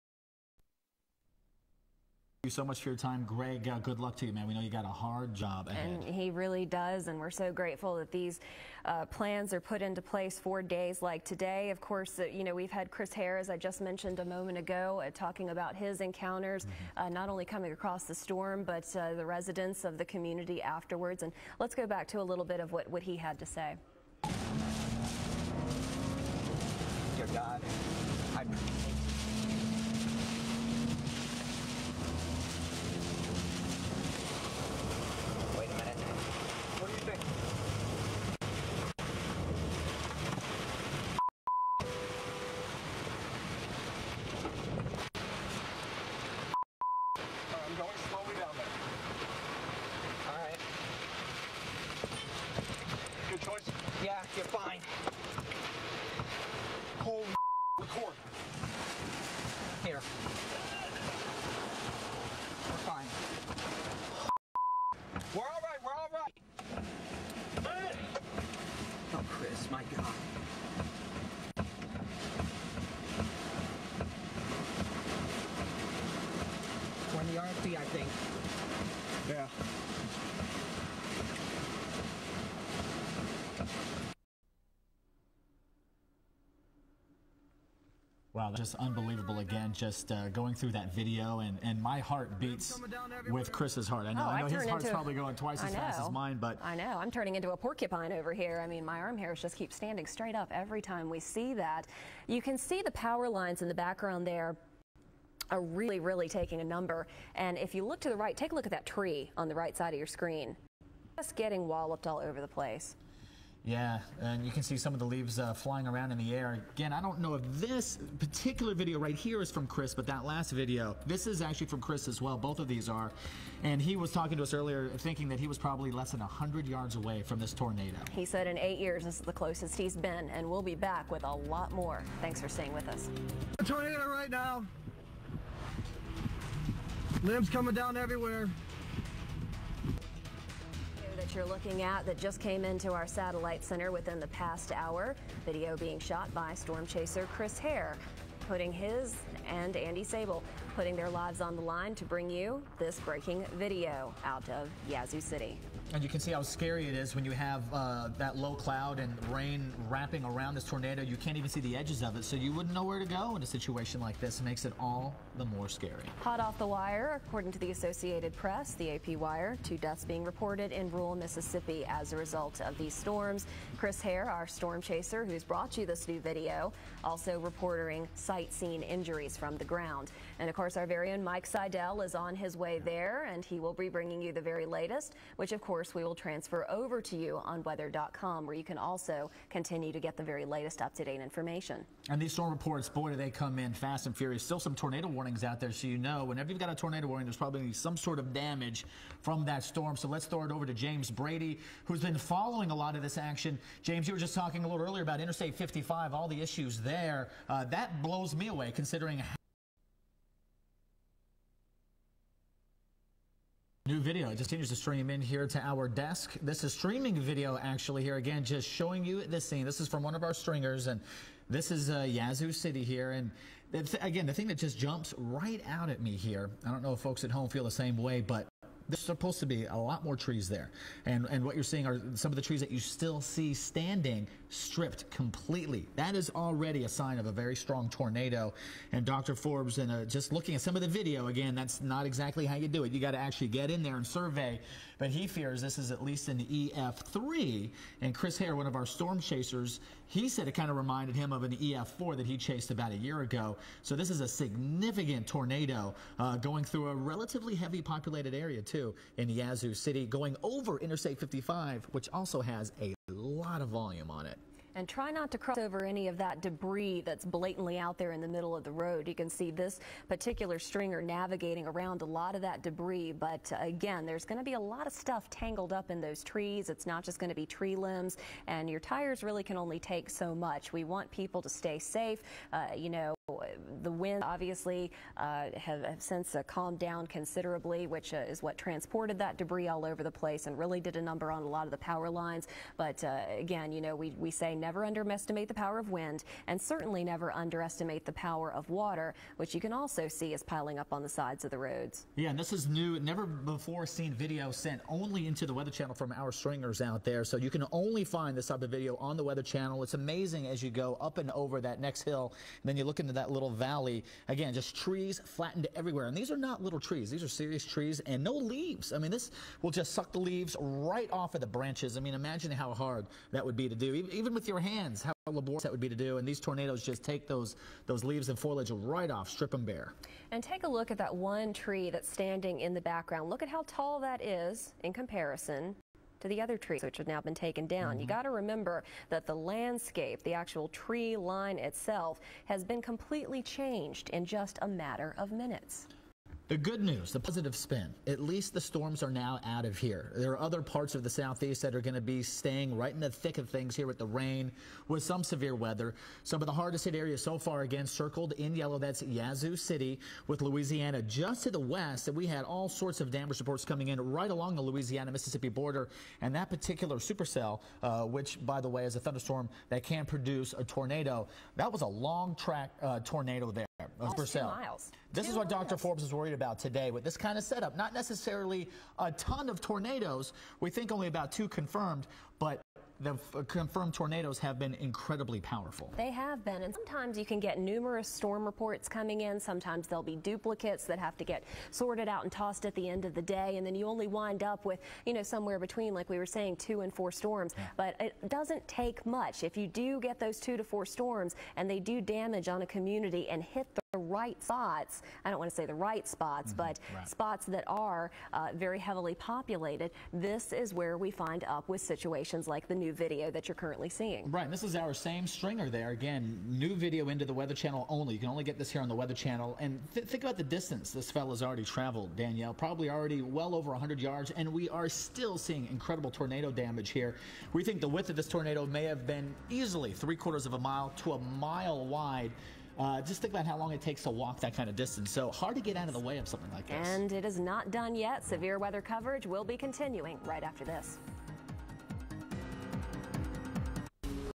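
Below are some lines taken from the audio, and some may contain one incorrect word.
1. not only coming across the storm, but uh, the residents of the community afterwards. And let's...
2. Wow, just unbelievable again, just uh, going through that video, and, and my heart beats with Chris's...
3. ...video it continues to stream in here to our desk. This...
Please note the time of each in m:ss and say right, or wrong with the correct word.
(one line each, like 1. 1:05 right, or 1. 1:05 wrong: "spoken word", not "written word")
1. 0:17 right
2. 1:28 right
3. 3:33 right.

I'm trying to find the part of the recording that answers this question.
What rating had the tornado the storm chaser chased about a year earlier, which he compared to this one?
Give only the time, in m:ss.
4:11.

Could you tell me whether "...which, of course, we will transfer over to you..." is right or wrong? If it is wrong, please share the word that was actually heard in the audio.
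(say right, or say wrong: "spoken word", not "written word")
right.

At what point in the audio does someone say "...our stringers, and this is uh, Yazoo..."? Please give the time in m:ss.
3:40.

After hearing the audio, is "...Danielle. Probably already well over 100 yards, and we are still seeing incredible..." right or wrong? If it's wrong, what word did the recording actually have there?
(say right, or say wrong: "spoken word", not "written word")
right.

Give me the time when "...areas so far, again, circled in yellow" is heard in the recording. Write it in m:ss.
5:56.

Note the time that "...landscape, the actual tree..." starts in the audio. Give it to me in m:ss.
5:39.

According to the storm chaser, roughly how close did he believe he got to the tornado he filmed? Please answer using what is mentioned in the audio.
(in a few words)
less than 100 yards.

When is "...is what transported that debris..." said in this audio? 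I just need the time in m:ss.
4:48.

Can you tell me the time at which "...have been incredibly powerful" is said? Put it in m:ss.
6:24.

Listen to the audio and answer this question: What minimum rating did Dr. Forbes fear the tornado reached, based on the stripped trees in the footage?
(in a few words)
EF3.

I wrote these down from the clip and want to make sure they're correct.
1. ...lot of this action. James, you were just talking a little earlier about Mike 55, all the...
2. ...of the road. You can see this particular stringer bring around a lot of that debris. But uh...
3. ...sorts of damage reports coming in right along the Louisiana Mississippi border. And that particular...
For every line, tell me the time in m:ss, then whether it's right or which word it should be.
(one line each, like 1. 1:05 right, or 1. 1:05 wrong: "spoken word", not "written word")
1. 3:22 wrong: "Interstate", not "Mike"
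2. 4:28 wrong: "navigating", not "bring"
3. 6:02 right.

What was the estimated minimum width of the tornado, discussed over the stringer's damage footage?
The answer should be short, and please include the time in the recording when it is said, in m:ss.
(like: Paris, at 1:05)
three quarters of a mile, at 7:10.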